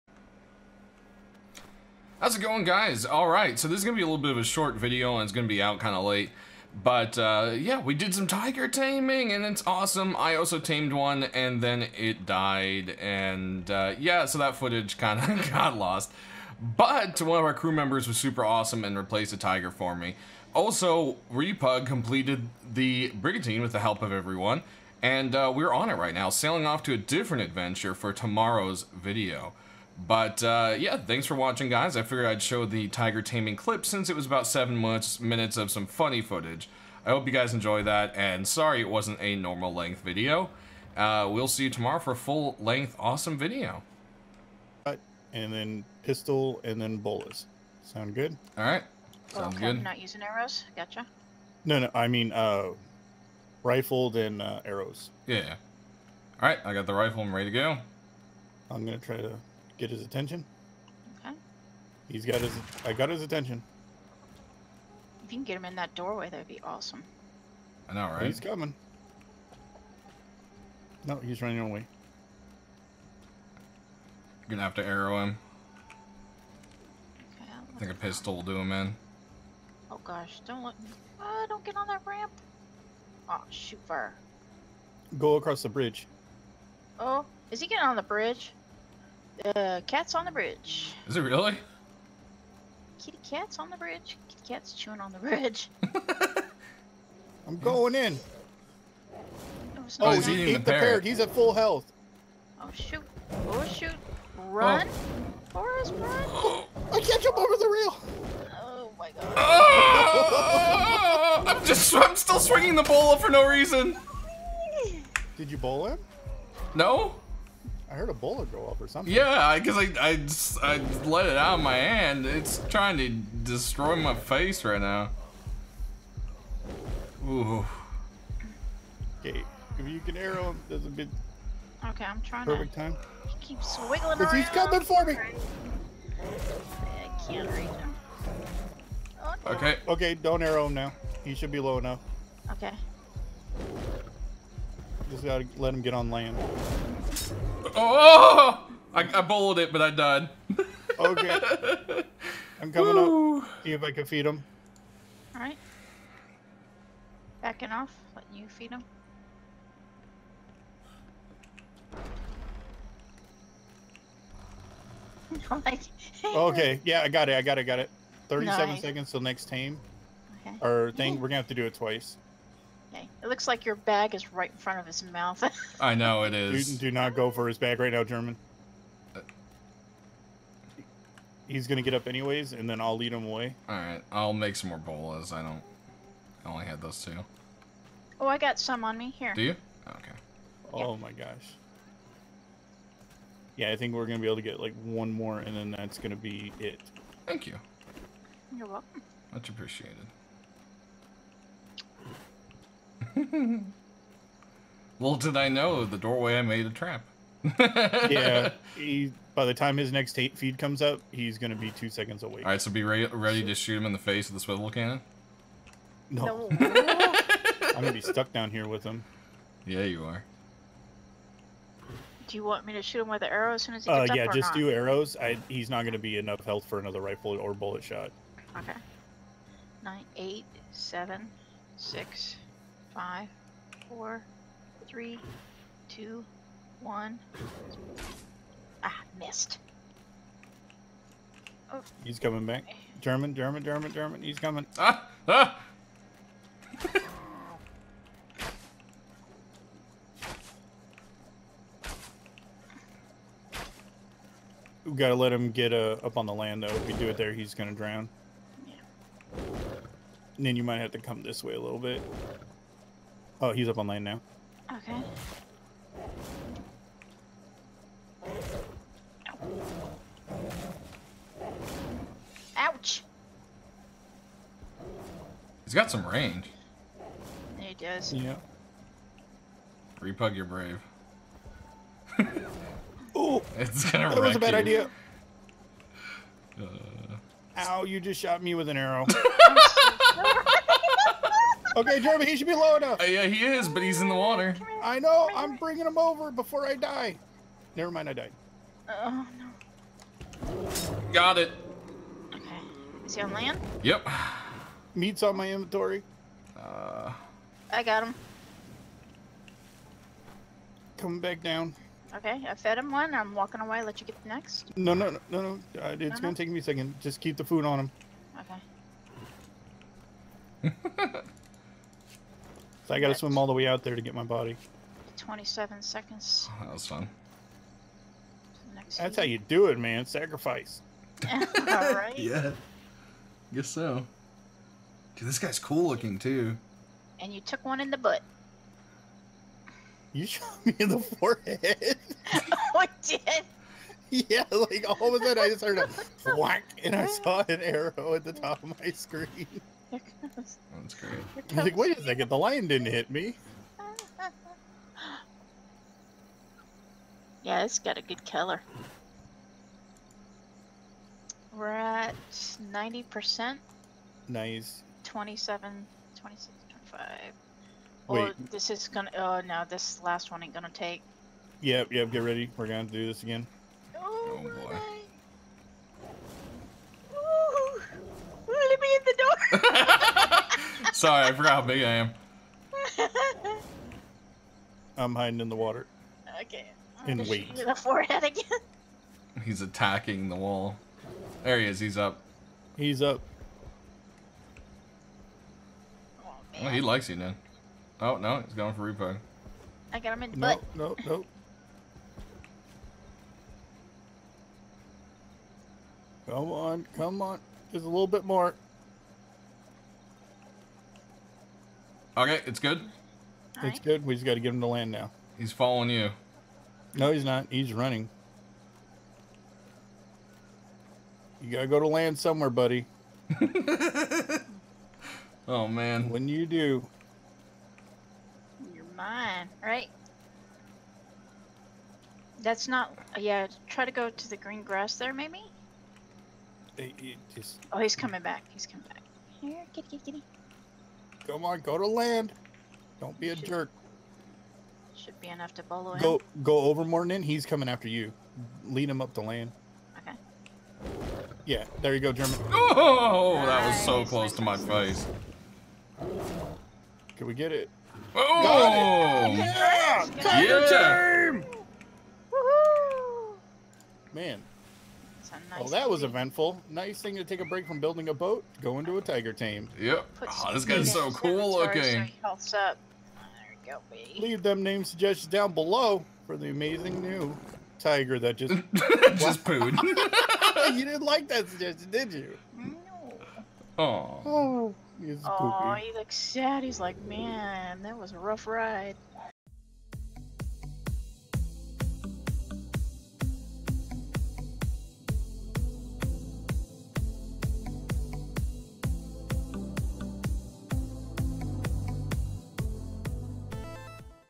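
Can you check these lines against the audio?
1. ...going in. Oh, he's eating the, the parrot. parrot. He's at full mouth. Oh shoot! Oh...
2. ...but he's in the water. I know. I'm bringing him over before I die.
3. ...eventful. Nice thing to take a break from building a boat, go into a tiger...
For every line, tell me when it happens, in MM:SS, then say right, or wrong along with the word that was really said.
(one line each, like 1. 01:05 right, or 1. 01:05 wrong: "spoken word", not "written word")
1. 01:37 wrong: "health", not "mouth"
2. 04:53 right
3. 07:46 right.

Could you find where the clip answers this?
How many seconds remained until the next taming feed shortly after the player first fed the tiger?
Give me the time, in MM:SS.
02:48.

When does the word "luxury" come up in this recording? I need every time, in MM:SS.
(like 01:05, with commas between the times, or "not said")
not said.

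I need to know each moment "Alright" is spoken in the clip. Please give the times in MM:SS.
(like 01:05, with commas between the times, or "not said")
02:35, 05:31.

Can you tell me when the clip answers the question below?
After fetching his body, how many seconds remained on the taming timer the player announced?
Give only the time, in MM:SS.
05:25.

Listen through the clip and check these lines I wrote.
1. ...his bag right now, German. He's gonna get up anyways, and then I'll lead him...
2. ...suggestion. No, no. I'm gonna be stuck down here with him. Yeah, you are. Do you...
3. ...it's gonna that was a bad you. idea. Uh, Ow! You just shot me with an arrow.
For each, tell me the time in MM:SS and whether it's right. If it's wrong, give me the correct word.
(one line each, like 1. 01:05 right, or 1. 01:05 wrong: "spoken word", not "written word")
1. 02:57 right
2. 03:34 wrong: "cannon", not "suggestion"
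3. 04:43 right.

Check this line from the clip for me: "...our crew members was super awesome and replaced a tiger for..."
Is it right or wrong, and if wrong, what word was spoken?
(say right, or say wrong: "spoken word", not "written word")
right.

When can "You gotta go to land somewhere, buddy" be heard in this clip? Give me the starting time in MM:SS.
07:01.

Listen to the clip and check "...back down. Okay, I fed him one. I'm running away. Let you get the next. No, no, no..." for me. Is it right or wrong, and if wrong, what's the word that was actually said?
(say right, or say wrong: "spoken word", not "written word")
wrong: "walking", not "running".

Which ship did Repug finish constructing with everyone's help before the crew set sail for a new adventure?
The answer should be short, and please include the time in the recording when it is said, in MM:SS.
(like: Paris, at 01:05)
Brigantine, at 00:23.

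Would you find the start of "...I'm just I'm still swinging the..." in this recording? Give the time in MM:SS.
01:51.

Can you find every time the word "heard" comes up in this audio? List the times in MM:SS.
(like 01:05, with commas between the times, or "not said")
01:57, 05:45.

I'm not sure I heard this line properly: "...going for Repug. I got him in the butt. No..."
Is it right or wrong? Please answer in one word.
right.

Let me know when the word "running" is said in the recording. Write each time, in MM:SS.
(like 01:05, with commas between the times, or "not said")
01:11, 06:57.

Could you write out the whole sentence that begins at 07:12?
That's not yeah, try to go to the green grass there maybe?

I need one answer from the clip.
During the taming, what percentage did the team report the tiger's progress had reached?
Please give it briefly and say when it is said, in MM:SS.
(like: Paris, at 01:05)
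90%, at 06:02.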